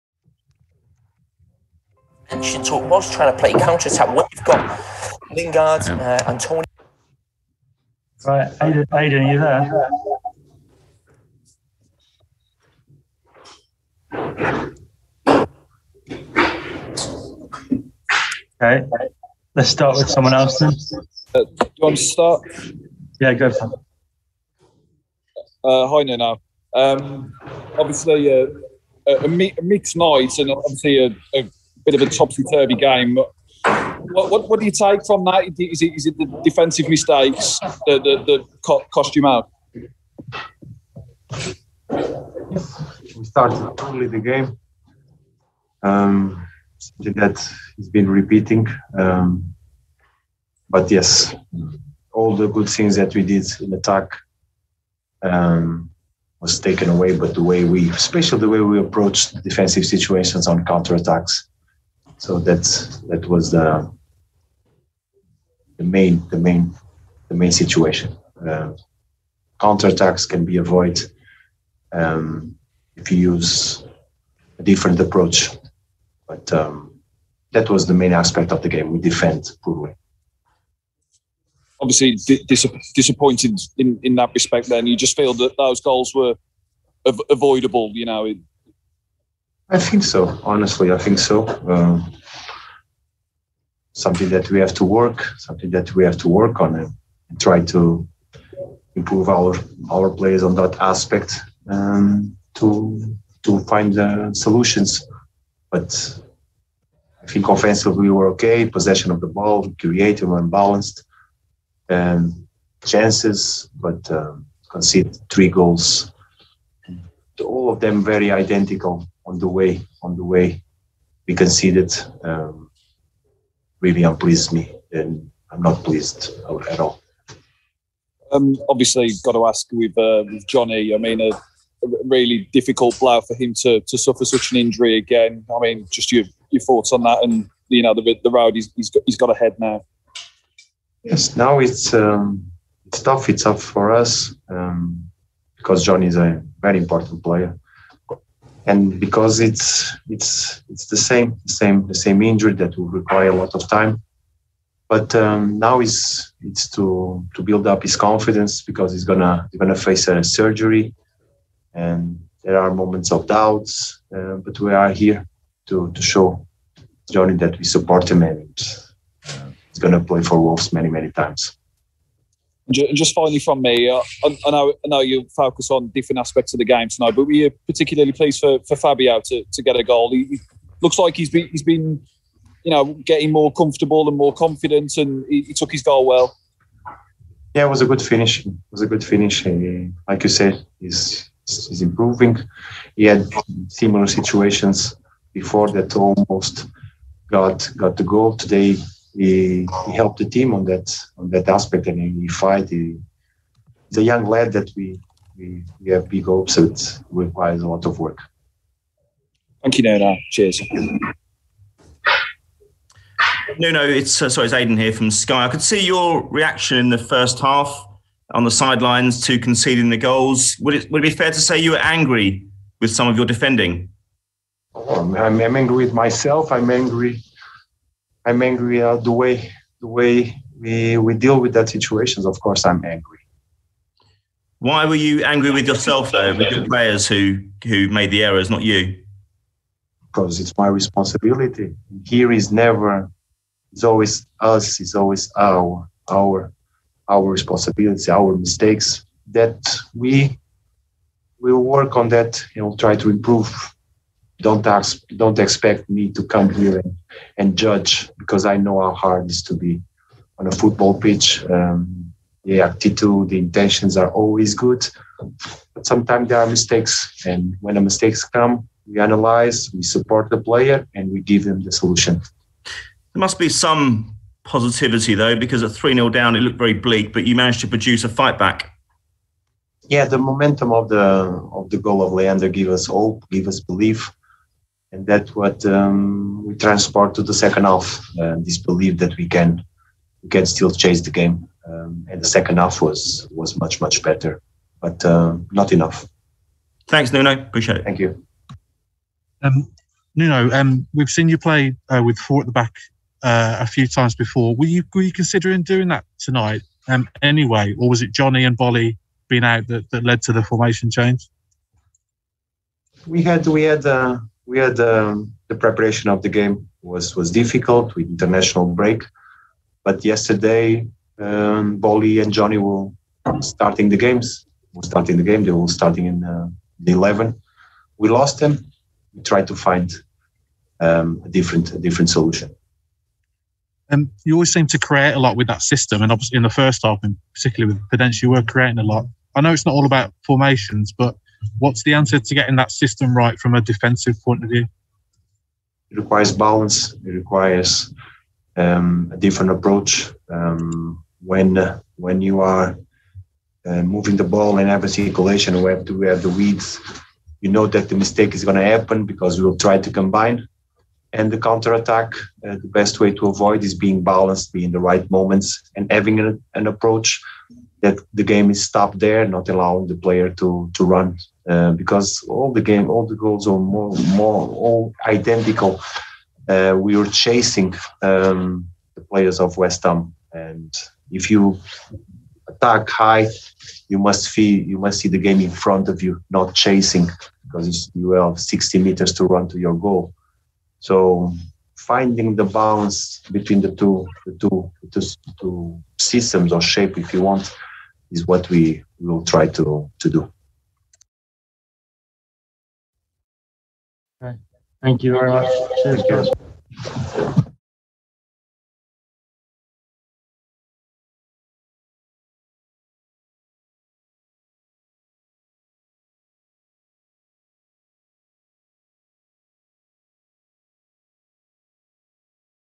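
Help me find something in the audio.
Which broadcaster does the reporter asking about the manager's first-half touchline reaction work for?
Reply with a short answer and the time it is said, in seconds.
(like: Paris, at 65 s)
Sky, at 215 s.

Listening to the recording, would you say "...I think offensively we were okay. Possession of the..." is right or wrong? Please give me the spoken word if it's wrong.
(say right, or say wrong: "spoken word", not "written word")
right.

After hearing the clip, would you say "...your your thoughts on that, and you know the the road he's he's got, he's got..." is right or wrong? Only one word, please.
right.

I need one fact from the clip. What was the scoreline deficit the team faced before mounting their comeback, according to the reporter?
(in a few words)
3-0.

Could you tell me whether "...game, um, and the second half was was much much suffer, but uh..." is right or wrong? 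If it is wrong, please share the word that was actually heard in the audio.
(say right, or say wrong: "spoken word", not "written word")
wrong: "better", not "suffer".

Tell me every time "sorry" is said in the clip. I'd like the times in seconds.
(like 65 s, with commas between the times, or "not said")
214 s.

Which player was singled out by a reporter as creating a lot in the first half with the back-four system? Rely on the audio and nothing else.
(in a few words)
Podence.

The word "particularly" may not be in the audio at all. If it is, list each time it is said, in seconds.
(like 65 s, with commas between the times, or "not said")
177 s, 337 s.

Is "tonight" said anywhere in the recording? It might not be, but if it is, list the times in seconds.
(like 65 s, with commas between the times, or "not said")
176 s, 306 s.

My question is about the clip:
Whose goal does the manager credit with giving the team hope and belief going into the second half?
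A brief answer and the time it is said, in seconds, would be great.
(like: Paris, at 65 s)
Leander, at 282 s.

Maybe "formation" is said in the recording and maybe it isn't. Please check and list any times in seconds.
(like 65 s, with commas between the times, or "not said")
310 s, 340 s.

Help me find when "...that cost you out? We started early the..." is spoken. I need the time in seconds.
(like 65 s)
38 s.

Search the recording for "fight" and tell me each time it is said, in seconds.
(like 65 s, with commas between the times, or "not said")
202 s, 278 s.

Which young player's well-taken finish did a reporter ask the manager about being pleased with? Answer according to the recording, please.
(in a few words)
Fabio.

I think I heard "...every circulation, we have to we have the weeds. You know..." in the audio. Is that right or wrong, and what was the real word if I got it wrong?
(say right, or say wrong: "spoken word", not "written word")
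right.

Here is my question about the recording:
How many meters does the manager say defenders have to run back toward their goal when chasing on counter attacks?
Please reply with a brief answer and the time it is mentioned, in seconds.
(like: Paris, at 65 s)
60, at 388 s.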